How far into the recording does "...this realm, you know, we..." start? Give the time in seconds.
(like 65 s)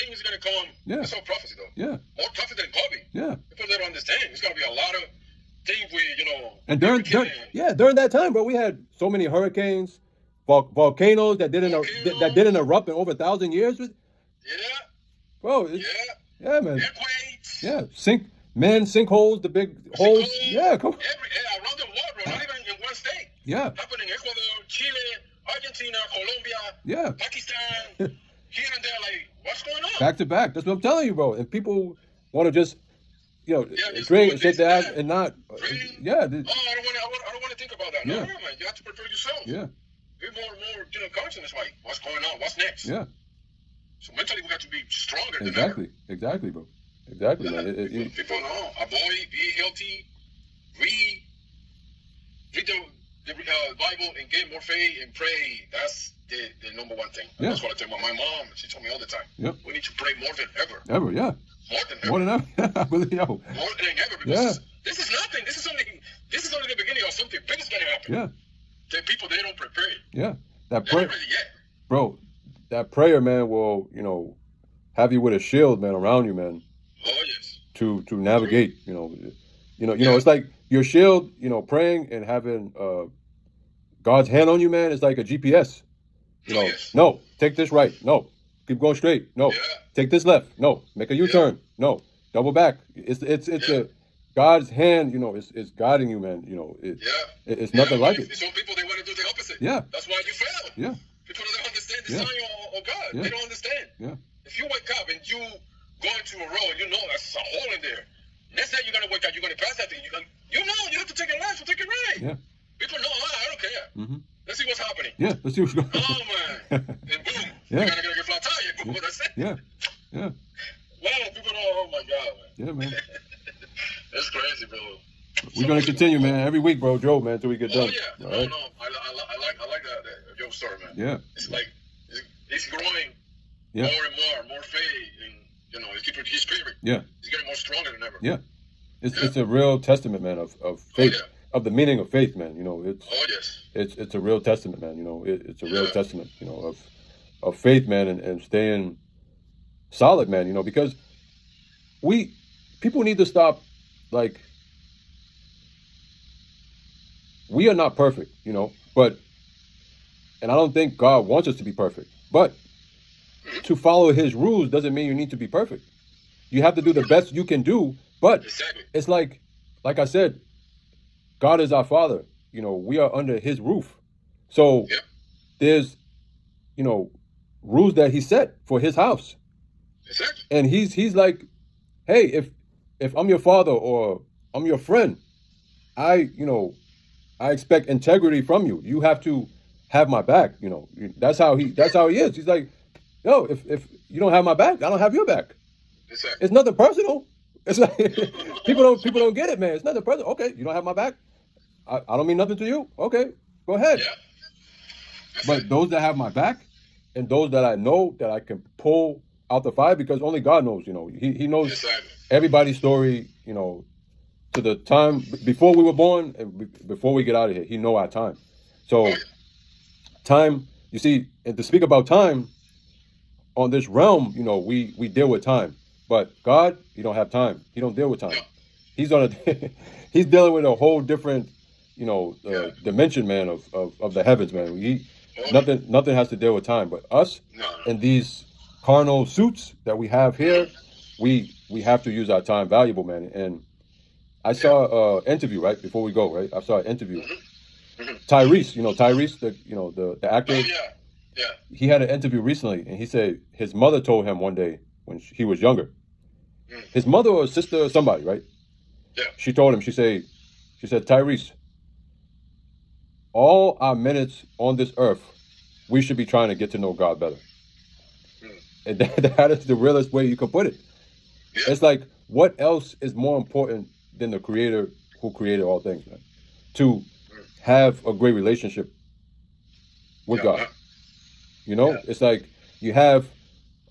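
223 s.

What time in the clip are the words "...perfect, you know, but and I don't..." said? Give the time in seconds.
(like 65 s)
157 s.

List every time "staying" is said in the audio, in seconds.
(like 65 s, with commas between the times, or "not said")
148 s.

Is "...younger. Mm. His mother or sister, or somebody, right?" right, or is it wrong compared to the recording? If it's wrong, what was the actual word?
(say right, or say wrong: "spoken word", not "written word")
right.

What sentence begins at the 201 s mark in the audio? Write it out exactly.
I I don't mean nothing to you.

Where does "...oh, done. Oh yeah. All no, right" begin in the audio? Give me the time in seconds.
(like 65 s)
127 s.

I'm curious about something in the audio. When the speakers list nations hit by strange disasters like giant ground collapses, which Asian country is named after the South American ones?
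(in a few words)
Pakistan.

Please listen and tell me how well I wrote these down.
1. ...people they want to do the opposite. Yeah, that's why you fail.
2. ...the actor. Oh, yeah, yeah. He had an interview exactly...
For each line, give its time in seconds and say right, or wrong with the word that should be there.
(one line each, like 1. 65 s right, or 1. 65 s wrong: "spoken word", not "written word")
1. 98 s right
2. 250 s wrong: "recently", not "exactly".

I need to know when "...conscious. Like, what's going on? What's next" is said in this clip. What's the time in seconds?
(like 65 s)
41 s.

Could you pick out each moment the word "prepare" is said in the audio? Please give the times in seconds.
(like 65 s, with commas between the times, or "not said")
38 s, 69 s.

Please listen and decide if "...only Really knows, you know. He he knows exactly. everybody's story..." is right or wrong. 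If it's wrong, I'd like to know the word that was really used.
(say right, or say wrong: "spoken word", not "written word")
wrong: "God", not "Really".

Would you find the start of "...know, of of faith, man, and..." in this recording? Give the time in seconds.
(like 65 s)
146 s.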